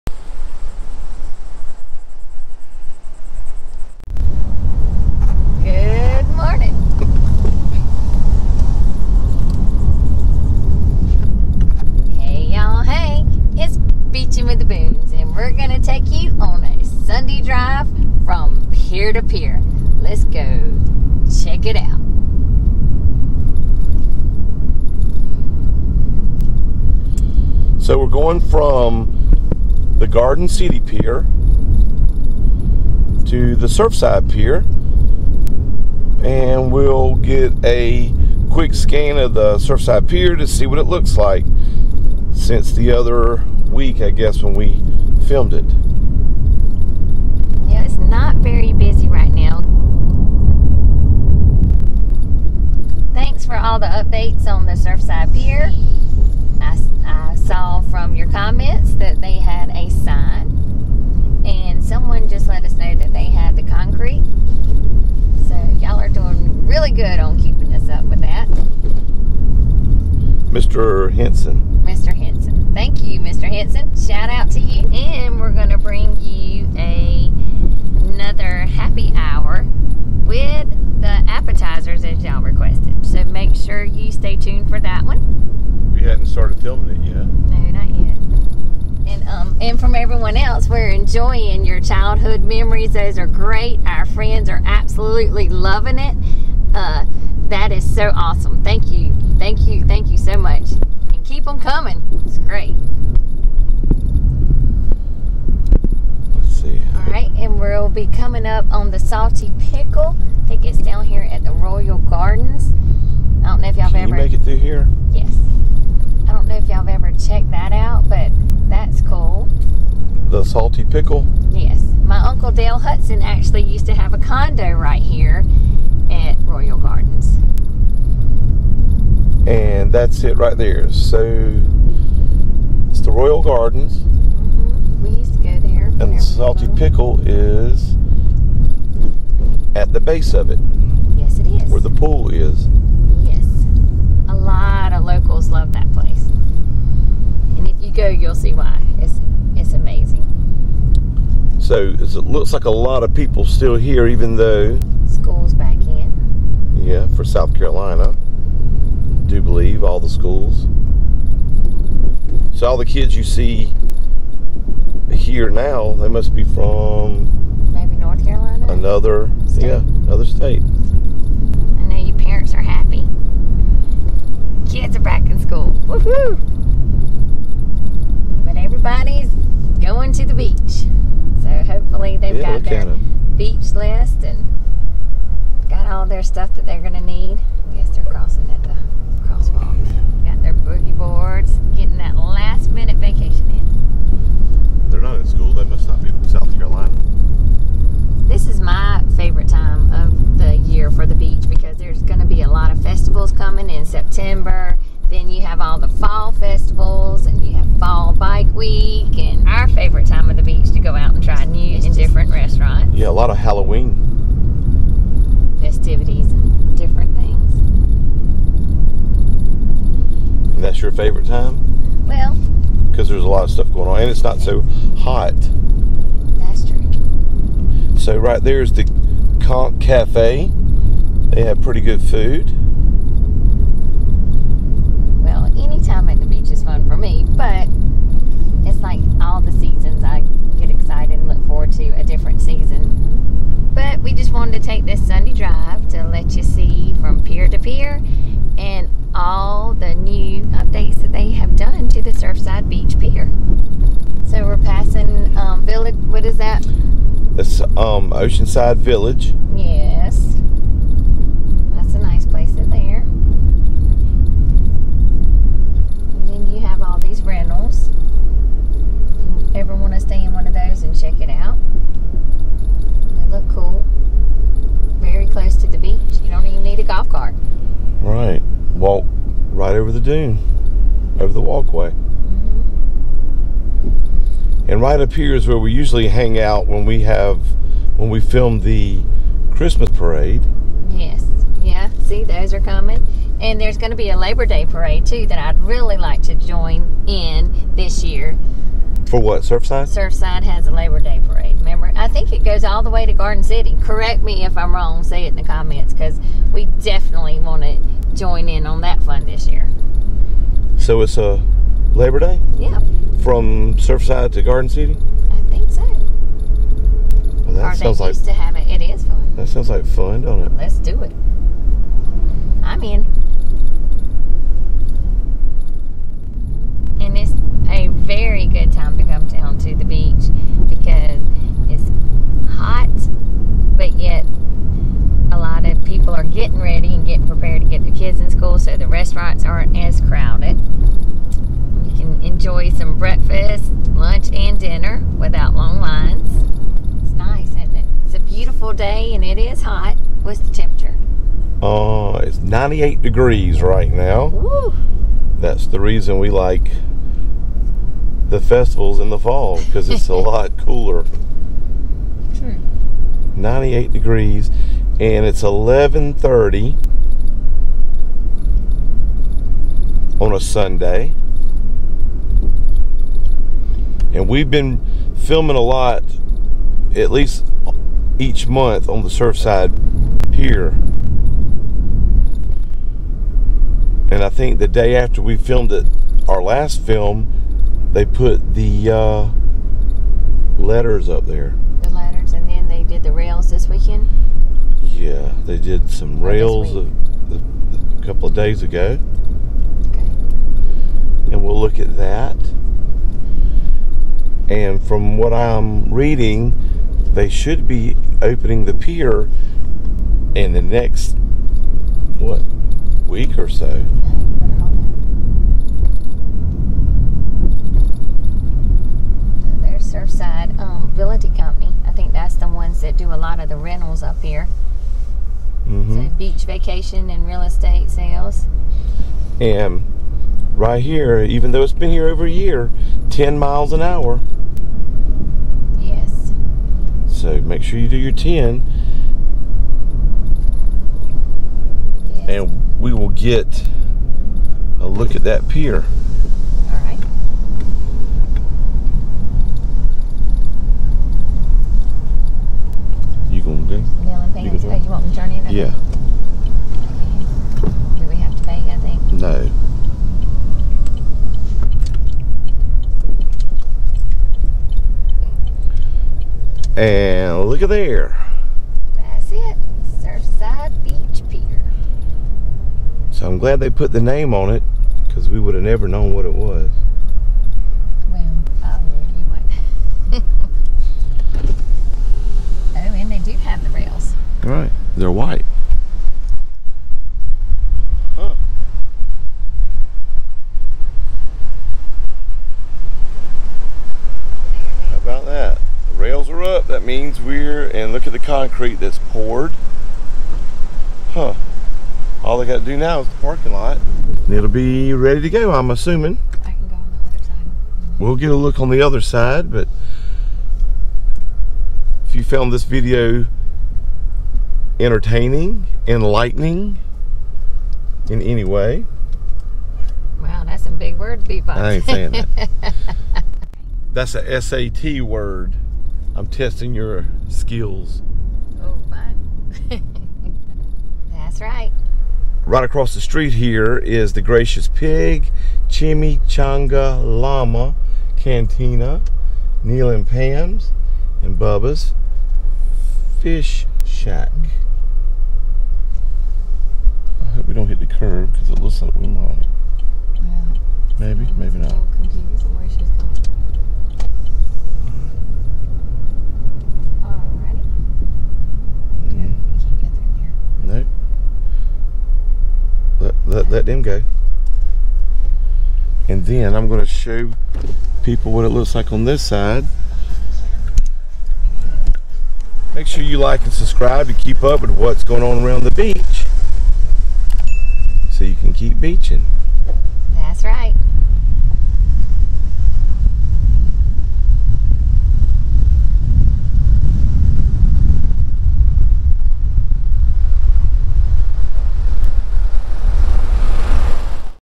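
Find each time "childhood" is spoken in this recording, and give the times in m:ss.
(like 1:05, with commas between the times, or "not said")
1:31.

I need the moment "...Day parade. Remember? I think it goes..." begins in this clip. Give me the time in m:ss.
5:01.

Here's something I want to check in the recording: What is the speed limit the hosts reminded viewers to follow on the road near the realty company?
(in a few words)
10 miles an hour.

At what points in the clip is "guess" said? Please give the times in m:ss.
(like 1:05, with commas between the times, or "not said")
0:44, 3:07.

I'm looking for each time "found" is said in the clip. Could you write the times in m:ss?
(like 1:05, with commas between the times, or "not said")
8:32.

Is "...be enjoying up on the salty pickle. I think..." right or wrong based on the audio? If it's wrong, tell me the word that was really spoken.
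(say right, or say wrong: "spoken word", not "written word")
wrong: "coming", not "enjoying".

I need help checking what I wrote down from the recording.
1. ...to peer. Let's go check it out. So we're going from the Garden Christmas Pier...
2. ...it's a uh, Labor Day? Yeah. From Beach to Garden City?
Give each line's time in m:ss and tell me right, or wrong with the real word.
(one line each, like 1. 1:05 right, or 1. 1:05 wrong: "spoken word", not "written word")
1. 0:19 wrong: "City", not "Christmas"
2. 5:11 wrong: "Surfside", not "Beach".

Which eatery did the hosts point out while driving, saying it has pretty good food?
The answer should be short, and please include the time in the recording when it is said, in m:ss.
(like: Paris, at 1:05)
Conch Cafe, at 3:49.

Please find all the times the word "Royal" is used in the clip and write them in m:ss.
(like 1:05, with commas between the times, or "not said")
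1:51, 2:06, 2:13.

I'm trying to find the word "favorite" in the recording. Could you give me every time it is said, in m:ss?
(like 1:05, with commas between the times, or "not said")
3:19, 3:29, 3:40.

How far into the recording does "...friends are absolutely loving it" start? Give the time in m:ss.
1:34.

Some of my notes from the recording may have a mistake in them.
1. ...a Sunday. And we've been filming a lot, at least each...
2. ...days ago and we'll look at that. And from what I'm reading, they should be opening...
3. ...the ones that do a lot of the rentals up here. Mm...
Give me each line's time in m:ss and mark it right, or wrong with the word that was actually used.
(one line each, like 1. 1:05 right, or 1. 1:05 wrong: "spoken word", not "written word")
1. 6:10 right
2. 6:38 right
3. 7:02 right.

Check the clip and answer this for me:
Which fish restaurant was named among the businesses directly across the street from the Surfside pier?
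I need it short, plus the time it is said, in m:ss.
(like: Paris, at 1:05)
Bubba's Fish Shack, at 9:01.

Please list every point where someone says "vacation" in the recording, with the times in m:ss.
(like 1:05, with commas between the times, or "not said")
3:12, 7:06.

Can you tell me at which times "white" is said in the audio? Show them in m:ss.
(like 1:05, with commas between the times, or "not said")
8:05.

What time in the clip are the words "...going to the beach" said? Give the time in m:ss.
2:59.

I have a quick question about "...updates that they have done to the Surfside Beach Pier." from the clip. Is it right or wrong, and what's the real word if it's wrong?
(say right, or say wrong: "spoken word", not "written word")
right.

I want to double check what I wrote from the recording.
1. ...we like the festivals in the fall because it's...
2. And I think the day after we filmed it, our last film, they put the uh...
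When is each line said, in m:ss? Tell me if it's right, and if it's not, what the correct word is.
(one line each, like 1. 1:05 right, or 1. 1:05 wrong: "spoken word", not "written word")
1. 5:56 right
2. 6:24 right.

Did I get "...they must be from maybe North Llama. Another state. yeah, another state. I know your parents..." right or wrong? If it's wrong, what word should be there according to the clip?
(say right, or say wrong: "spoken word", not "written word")
wrong: "Carolina", not "Llama".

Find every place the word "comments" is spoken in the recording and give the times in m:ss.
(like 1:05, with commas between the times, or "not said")
0:58, 5:05.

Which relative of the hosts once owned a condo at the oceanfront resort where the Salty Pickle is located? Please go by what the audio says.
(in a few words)
Uncle Dale Hudson.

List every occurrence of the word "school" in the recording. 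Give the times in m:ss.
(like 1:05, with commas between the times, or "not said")
2:35, 2:40, 2:55, 3:15.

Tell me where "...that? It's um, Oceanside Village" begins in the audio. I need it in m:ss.
4:16.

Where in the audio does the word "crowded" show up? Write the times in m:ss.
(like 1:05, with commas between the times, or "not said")
5:40.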